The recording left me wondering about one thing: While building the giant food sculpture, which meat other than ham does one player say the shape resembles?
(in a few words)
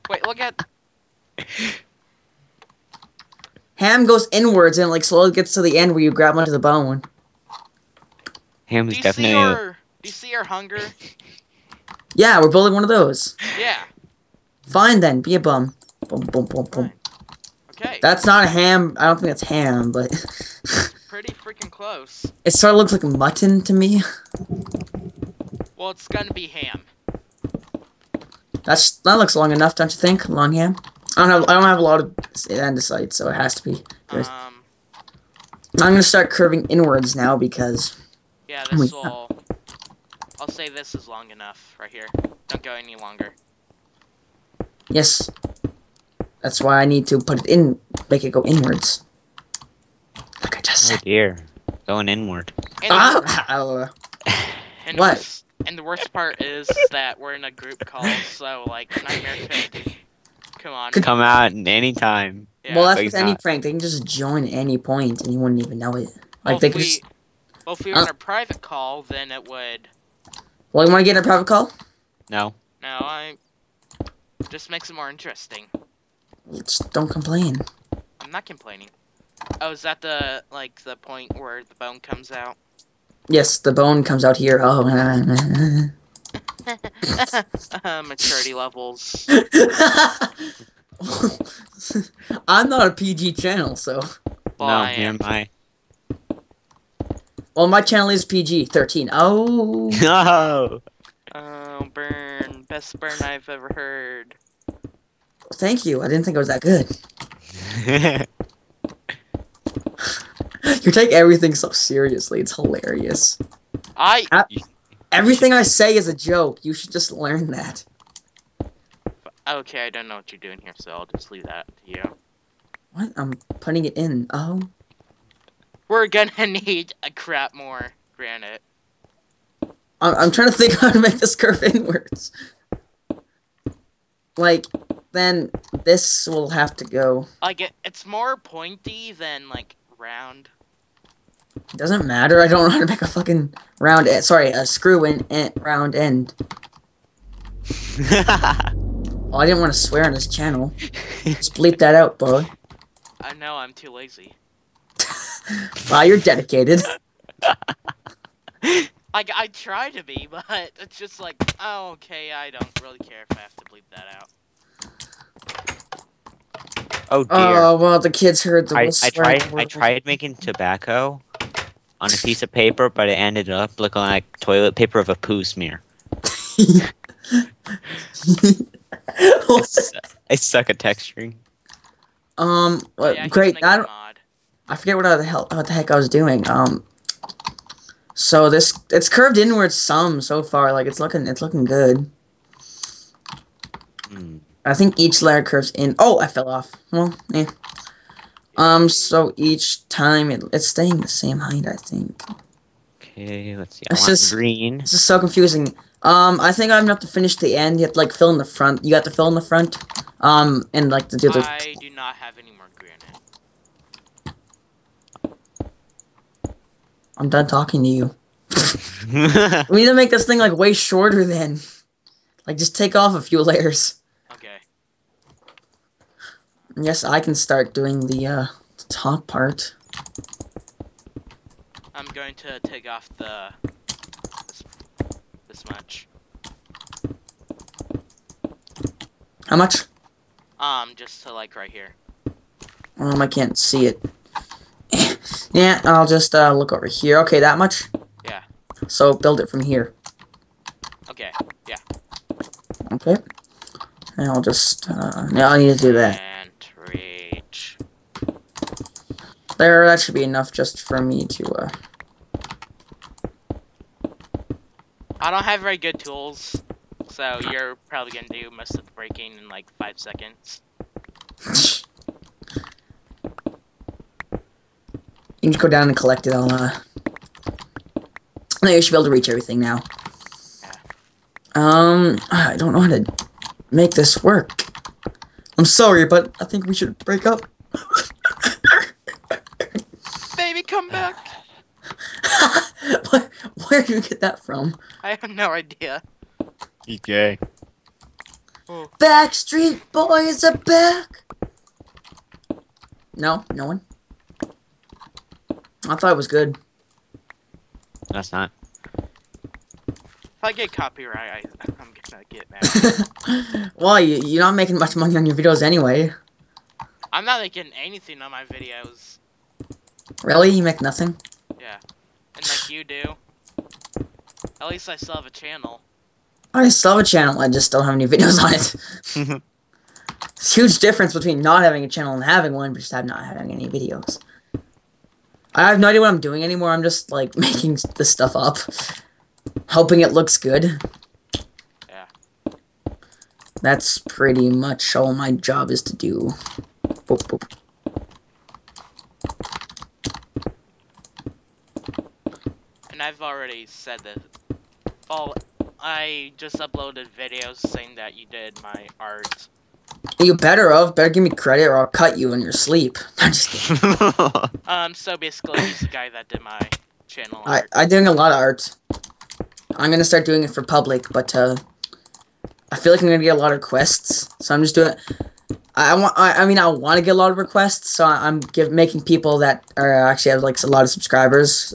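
Mutton.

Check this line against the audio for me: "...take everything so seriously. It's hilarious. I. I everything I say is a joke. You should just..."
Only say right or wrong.
right.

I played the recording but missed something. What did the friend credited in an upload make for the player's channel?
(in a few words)
Channel art.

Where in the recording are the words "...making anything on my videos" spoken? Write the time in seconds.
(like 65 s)
317 s.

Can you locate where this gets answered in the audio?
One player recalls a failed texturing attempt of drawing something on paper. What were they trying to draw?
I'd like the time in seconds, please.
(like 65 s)
170 s.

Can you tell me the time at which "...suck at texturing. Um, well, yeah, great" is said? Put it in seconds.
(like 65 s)
180 s.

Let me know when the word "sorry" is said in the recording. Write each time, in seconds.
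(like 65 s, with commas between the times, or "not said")
144 s, 285 s.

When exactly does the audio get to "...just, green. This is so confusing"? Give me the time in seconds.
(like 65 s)
204 s.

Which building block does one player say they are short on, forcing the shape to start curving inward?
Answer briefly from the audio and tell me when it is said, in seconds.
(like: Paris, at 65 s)
Andesite, at 32 s.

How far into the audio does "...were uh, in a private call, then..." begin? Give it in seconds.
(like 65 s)
67 s.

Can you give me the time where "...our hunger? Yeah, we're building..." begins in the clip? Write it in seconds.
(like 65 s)
10 s.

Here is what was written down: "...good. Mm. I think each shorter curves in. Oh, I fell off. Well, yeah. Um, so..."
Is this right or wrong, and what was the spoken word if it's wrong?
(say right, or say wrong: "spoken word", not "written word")
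wrong: "layer", not "shorter".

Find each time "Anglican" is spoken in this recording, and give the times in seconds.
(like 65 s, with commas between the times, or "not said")
not said.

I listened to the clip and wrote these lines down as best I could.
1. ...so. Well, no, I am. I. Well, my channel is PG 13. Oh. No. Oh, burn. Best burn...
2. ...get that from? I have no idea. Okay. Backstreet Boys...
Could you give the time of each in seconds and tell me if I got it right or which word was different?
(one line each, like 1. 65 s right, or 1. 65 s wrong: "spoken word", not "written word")
1. 93 s right
2. 294 s right.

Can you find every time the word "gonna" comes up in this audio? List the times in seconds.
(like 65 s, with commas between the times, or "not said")
26 s, 35 s, 126 s, 268 s, 312 s.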